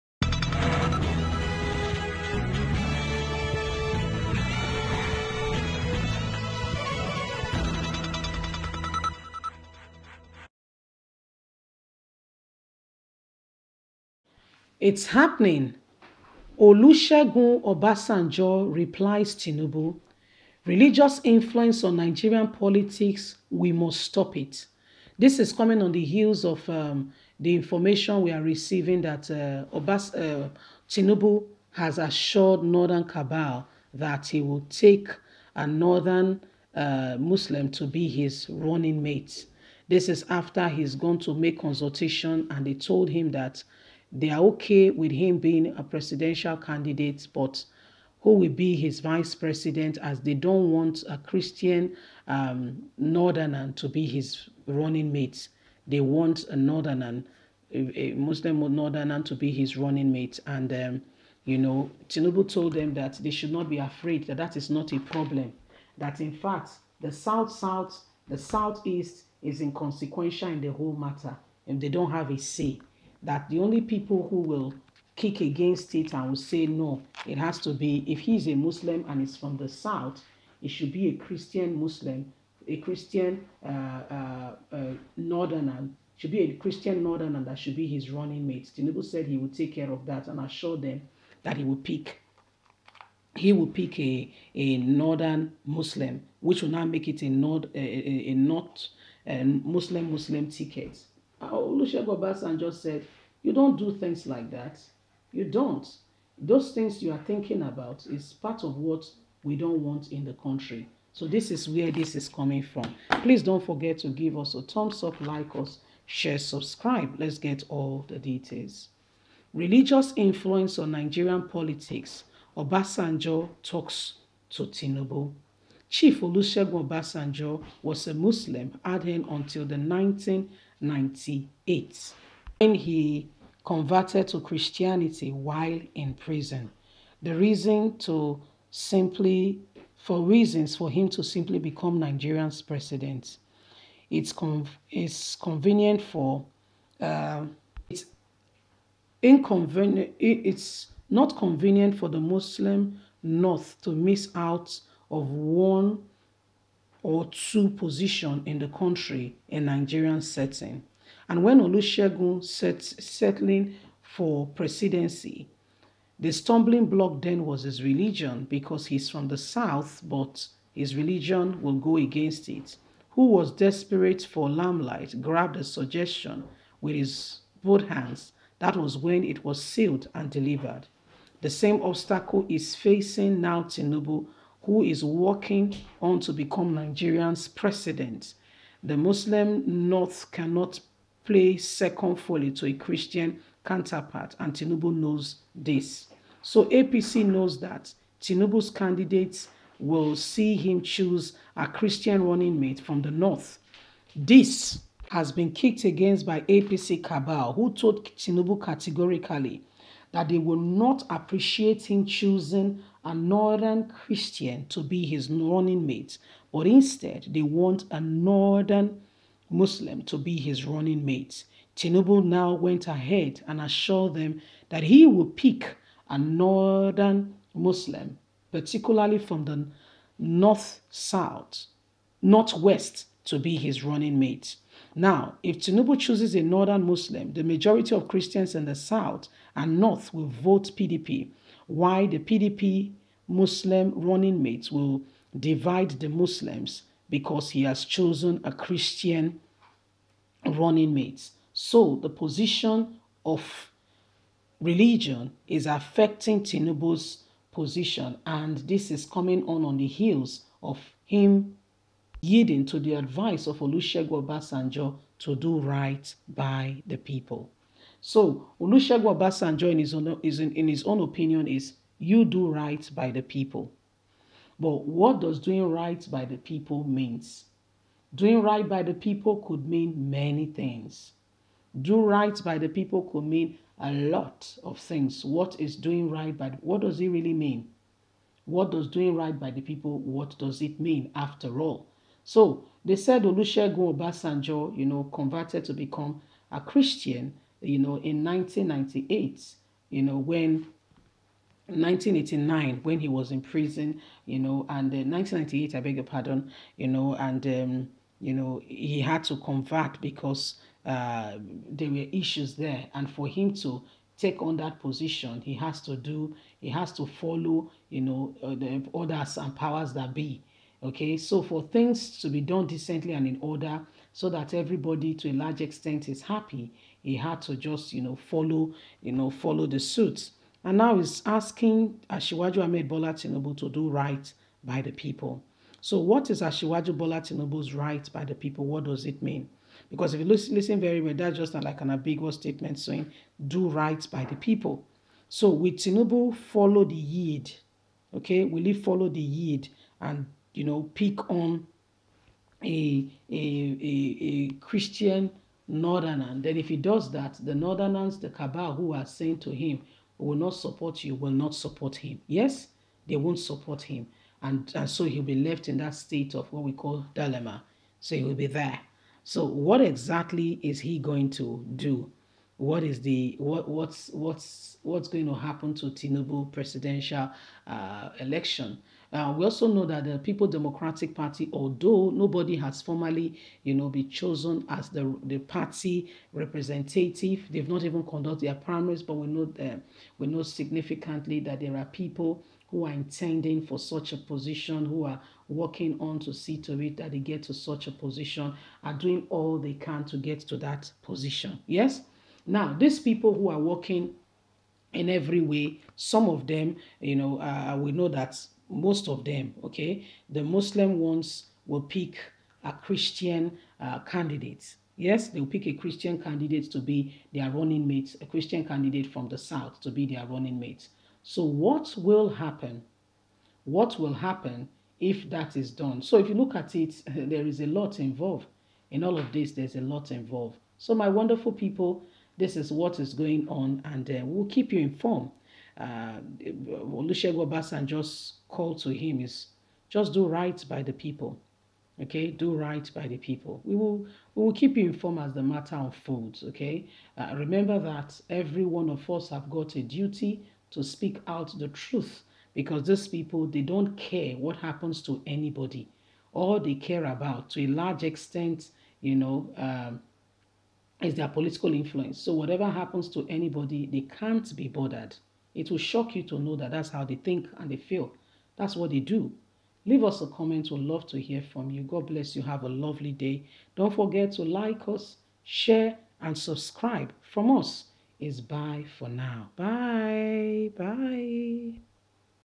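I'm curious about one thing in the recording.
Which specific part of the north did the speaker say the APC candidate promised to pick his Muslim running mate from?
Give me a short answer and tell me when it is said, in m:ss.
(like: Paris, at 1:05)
Northwest, at 3:52.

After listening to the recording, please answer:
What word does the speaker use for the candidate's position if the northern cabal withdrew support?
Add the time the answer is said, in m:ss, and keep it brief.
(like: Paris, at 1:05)
Dilemma, at 6:07.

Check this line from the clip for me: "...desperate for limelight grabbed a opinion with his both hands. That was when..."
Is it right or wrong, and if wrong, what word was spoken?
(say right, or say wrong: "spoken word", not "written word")
wrong: "suggestion", not "opinion".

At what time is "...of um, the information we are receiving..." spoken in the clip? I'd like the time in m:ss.
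0:26.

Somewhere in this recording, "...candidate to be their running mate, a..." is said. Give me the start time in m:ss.
6:56.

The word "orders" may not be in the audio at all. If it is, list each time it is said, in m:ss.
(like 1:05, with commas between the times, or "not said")
5:18, 5:23.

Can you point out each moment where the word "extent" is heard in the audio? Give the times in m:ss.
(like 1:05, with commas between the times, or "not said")
5:25, 7:38.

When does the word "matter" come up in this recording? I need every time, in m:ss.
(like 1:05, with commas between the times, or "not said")
1:10, 7:25.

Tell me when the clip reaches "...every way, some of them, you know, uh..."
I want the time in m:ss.
6:45.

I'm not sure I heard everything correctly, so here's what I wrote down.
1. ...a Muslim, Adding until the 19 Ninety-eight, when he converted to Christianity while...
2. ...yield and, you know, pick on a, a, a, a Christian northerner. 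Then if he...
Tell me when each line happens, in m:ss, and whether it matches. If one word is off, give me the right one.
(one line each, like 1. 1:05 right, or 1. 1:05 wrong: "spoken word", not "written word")
1. 2:08 right
2. 5:49 right.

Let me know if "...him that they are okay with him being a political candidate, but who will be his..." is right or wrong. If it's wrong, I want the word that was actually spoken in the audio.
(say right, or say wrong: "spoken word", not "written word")
wrong: "presidential", not "political".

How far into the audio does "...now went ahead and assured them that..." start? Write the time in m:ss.
3:42.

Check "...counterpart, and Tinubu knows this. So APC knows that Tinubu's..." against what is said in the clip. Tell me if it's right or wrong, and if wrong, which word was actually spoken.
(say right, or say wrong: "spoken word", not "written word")
right.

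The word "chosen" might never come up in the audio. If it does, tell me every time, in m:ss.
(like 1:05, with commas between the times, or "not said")
4:07, 6:24.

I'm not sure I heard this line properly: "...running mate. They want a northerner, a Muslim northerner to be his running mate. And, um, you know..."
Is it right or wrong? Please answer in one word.
right.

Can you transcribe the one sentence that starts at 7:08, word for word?
In all of this, there's a lot involved.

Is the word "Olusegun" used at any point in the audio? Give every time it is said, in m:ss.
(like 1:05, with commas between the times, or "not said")
0:16, 1:41, 2:06, 2:41, 4:23, 4:28, 4:53, 7:16.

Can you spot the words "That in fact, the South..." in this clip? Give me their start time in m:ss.
1:05.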